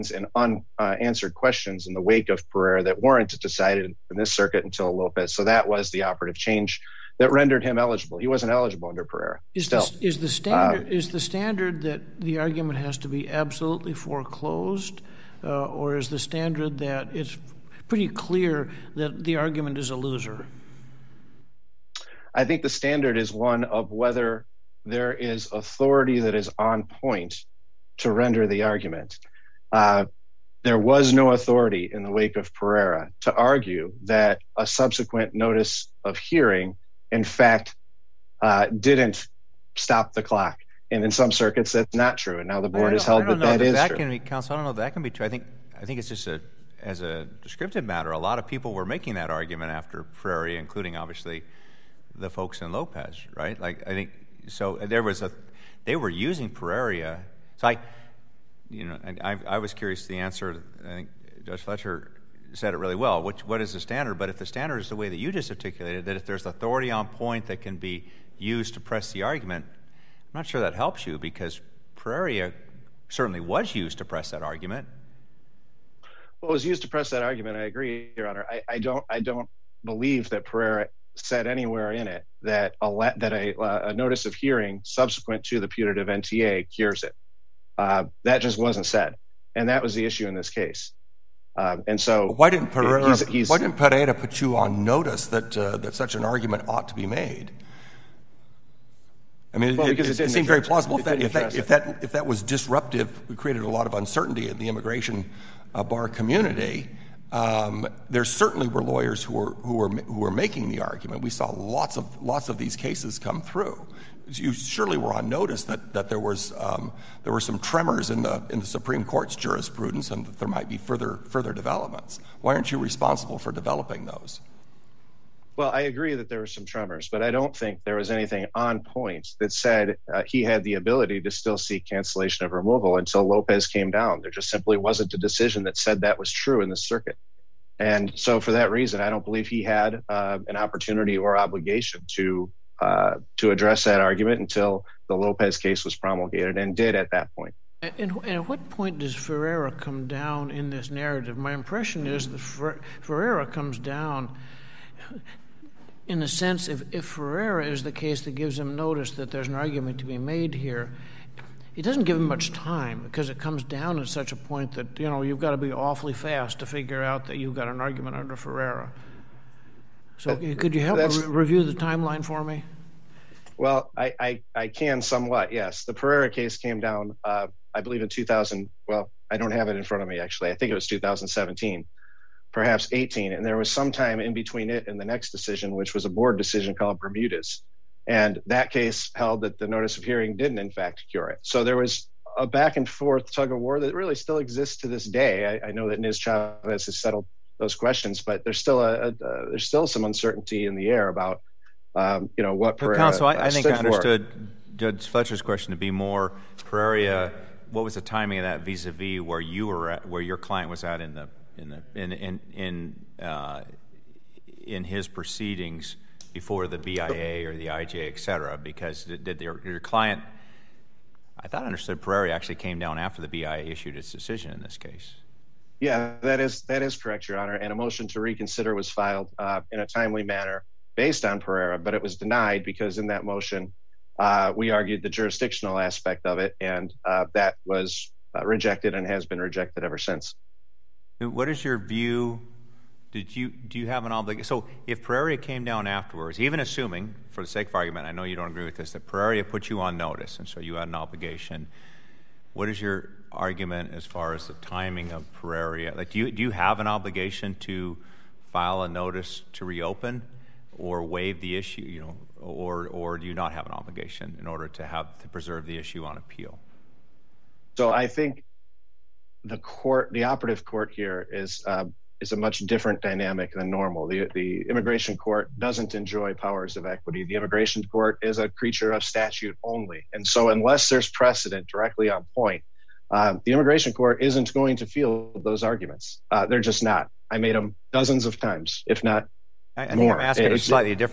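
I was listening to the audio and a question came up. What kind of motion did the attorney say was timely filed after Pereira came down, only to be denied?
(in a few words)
motion to reconsider.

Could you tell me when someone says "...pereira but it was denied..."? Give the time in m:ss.
3:51.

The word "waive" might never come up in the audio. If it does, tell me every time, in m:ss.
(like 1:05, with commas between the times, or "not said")
4:21.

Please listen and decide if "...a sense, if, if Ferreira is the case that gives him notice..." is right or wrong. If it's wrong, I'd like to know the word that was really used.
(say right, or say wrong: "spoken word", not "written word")
right.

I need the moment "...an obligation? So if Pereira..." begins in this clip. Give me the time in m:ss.
4:04.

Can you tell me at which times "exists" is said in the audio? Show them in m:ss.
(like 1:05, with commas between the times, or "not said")
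3:14.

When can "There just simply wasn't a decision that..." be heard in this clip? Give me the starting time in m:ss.
2:14.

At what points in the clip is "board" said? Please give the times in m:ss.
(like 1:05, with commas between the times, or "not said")
0:42, 3:06.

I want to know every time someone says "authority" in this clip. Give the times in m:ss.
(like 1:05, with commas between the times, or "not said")
0:25, 0:31, 1:06.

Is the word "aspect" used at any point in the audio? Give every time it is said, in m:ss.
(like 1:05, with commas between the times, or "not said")
3:55.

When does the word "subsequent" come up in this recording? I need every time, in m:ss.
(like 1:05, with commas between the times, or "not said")
0:34, 1:24.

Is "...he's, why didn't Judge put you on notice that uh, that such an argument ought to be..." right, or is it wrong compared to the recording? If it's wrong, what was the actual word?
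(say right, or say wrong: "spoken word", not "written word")
wrong: "Pereira", not "Judge".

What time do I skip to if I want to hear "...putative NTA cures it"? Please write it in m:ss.
1:25.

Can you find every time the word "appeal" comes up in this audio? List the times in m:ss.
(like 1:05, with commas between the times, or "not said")
4:26.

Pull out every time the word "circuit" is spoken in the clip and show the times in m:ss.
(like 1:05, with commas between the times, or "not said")
0:04, 0:41, 2:16.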